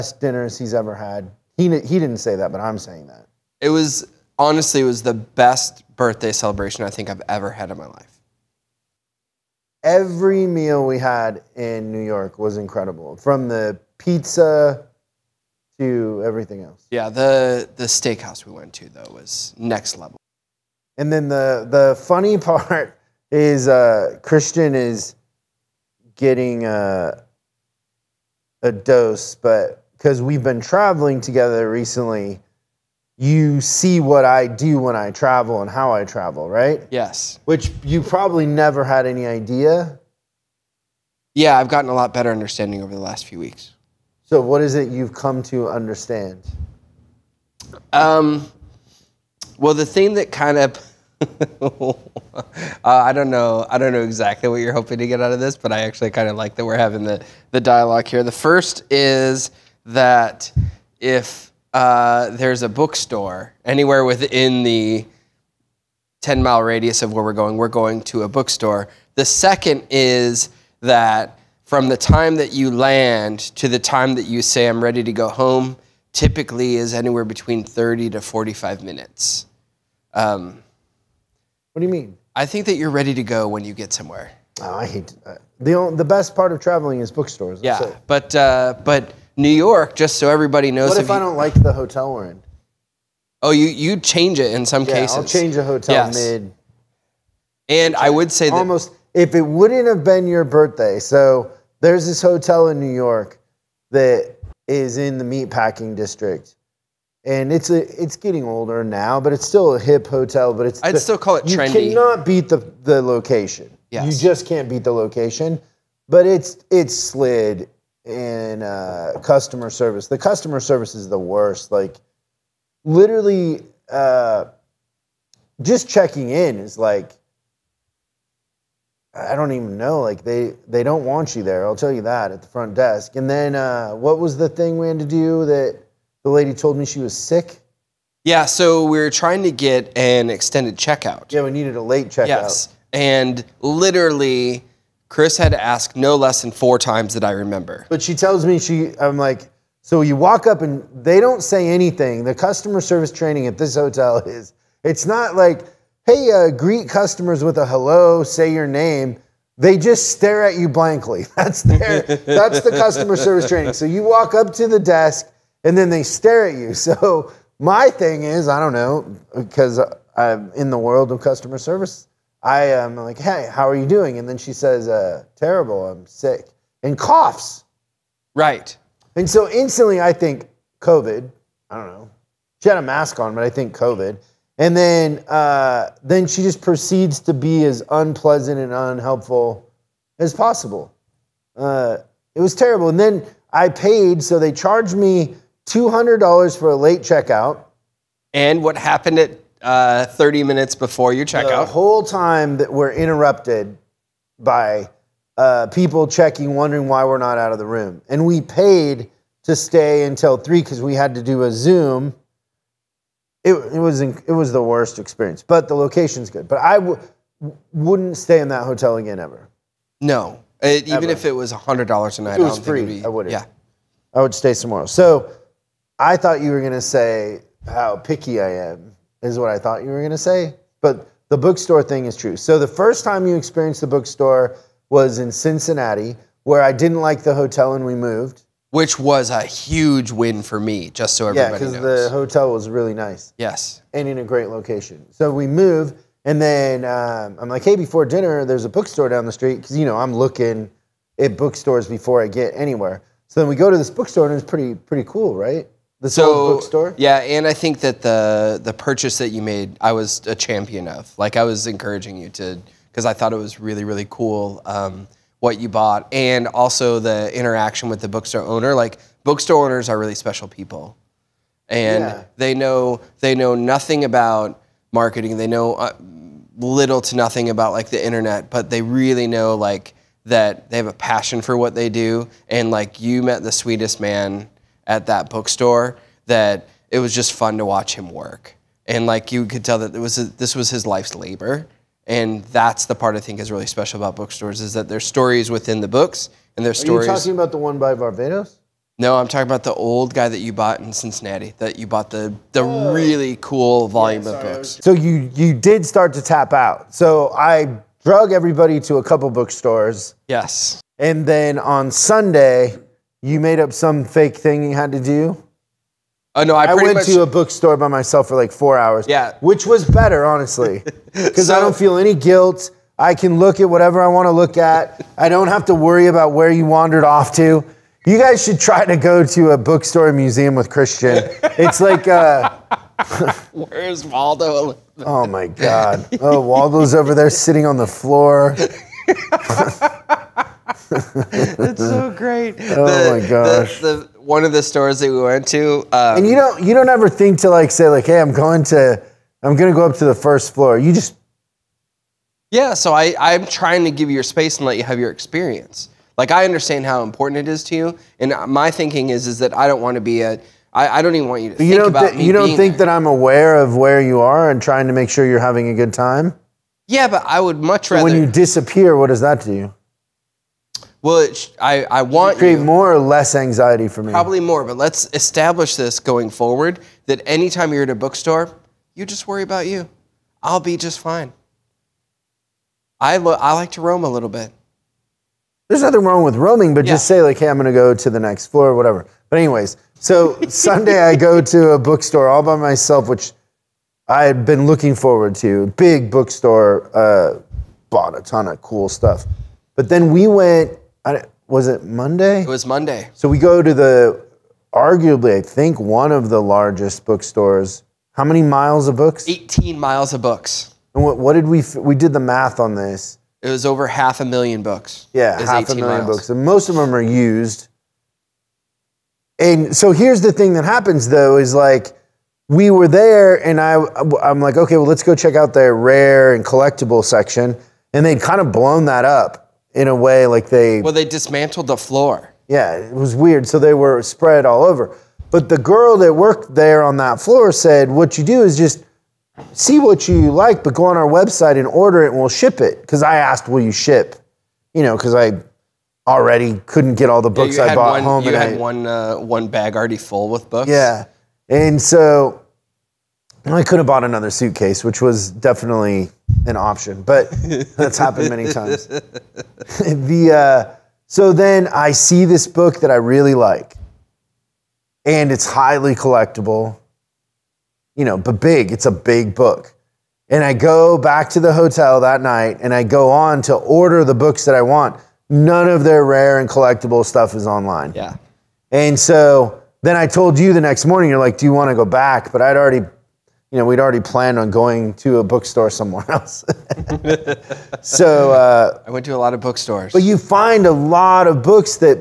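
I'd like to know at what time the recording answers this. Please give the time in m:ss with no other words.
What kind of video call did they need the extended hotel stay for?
3:31.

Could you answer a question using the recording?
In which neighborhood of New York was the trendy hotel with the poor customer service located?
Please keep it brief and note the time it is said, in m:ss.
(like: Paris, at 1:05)
Meatpacking district, at 1:45.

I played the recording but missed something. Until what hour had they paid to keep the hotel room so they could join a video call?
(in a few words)
3.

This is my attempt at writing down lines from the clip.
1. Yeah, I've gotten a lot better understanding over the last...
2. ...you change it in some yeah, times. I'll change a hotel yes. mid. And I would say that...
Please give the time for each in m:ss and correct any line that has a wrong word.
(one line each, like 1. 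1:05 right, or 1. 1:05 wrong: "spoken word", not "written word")
1. 0:41 right
2. 1:33 wrong: "cases", not "times".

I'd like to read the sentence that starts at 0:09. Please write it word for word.
Every meal we had in New York was incredible, from the pizza to everything else.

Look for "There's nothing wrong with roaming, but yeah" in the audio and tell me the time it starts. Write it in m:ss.
6:25.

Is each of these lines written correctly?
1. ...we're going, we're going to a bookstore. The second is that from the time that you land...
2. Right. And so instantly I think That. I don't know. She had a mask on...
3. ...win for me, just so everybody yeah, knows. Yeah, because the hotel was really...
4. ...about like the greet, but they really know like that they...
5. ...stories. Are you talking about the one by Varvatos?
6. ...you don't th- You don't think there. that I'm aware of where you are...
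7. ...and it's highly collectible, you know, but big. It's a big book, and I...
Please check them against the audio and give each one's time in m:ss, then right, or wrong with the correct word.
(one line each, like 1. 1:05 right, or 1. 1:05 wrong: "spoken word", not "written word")
1. 1:07 right
2. 2:58 wrong: "COVID", not "That"
3. 4:00 right
4. 4:37 wrong: "internet", not "greet"
5. 4:56 right
6. 6:01 right
7. 7:45 right.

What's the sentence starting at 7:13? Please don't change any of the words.
So they were spread all over.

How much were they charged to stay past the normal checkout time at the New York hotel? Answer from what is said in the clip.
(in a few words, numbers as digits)
$200.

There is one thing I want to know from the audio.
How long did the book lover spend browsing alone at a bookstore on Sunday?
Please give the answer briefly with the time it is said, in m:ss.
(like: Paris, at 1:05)
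4 hours, at 5:18.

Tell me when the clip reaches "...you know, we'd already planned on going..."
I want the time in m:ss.
8:03.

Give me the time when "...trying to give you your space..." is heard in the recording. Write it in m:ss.
5:53.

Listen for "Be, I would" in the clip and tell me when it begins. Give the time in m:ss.
3:42.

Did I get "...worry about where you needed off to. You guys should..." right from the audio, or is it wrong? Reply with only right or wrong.
wrong.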